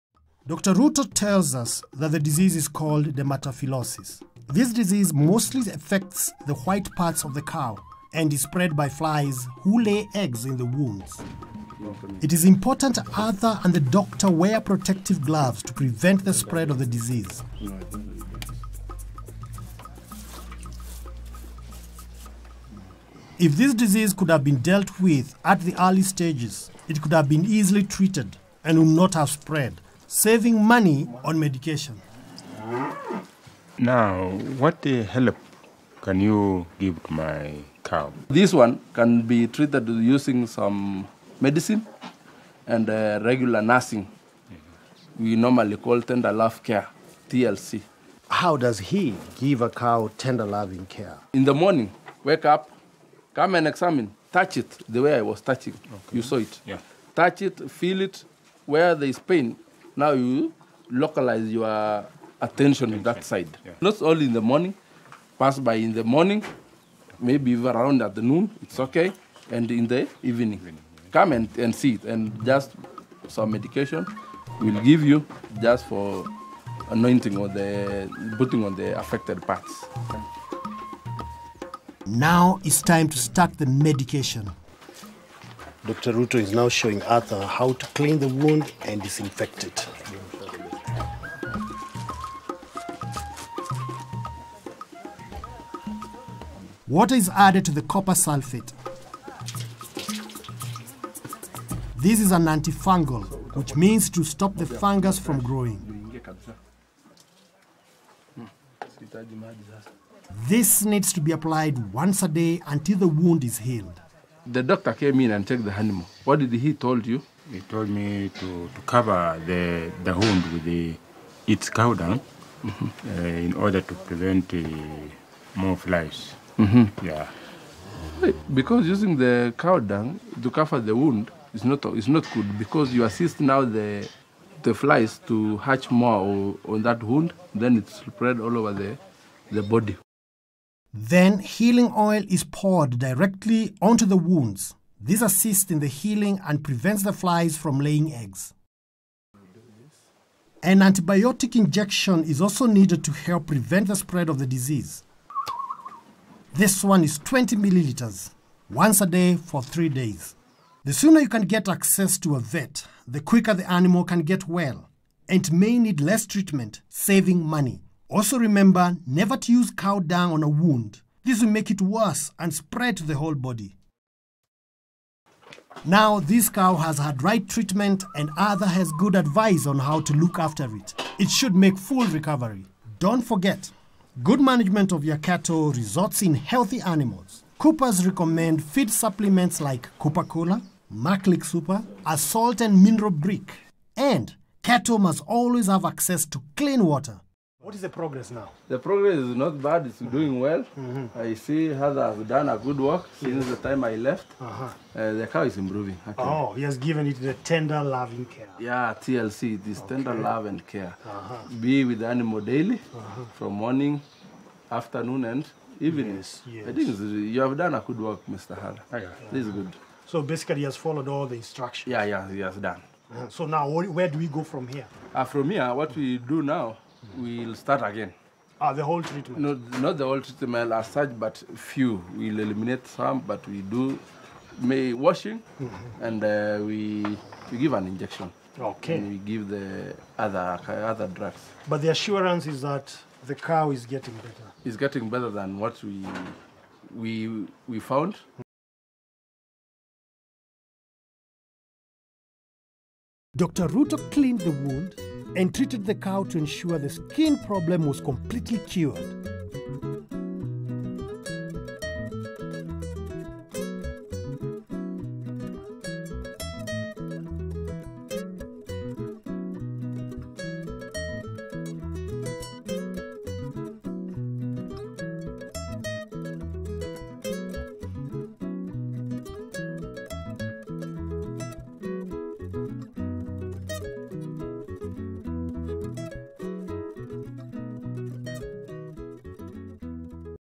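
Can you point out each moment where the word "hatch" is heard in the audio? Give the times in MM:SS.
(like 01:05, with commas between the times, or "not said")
02:15.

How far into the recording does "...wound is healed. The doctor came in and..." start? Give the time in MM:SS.
01:53.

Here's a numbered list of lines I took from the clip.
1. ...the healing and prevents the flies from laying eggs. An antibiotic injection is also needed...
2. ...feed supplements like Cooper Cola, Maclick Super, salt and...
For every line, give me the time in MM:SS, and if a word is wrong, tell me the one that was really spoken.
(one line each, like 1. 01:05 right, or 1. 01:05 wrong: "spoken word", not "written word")
1. 02:25 right
2. 03:08 right.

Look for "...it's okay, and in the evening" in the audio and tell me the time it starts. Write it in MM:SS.
01:08.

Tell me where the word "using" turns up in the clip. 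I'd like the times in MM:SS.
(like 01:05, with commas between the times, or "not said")
00:39, 02:08.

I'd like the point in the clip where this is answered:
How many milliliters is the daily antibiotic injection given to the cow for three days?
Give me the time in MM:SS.
02:37.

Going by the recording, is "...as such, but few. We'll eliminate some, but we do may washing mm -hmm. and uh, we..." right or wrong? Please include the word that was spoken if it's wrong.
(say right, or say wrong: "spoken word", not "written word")
right.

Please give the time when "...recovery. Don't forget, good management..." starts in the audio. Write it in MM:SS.
03:02.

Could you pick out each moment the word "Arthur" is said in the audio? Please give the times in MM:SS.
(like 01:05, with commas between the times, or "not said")
00:13, 01:27, 02:58, 03:21, 03:38.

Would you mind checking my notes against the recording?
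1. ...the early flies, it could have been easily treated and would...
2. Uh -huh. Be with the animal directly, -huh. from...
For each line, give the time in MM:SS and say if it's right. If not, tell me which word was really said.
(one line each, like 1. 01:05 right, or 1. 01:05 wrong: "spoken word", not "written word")
1. 00:25 wrong: "stages", not "flies"
2. 03:31 wrong: "daily", not "directly".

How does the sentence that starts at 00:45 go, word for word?
We normally call tender love care, TLC.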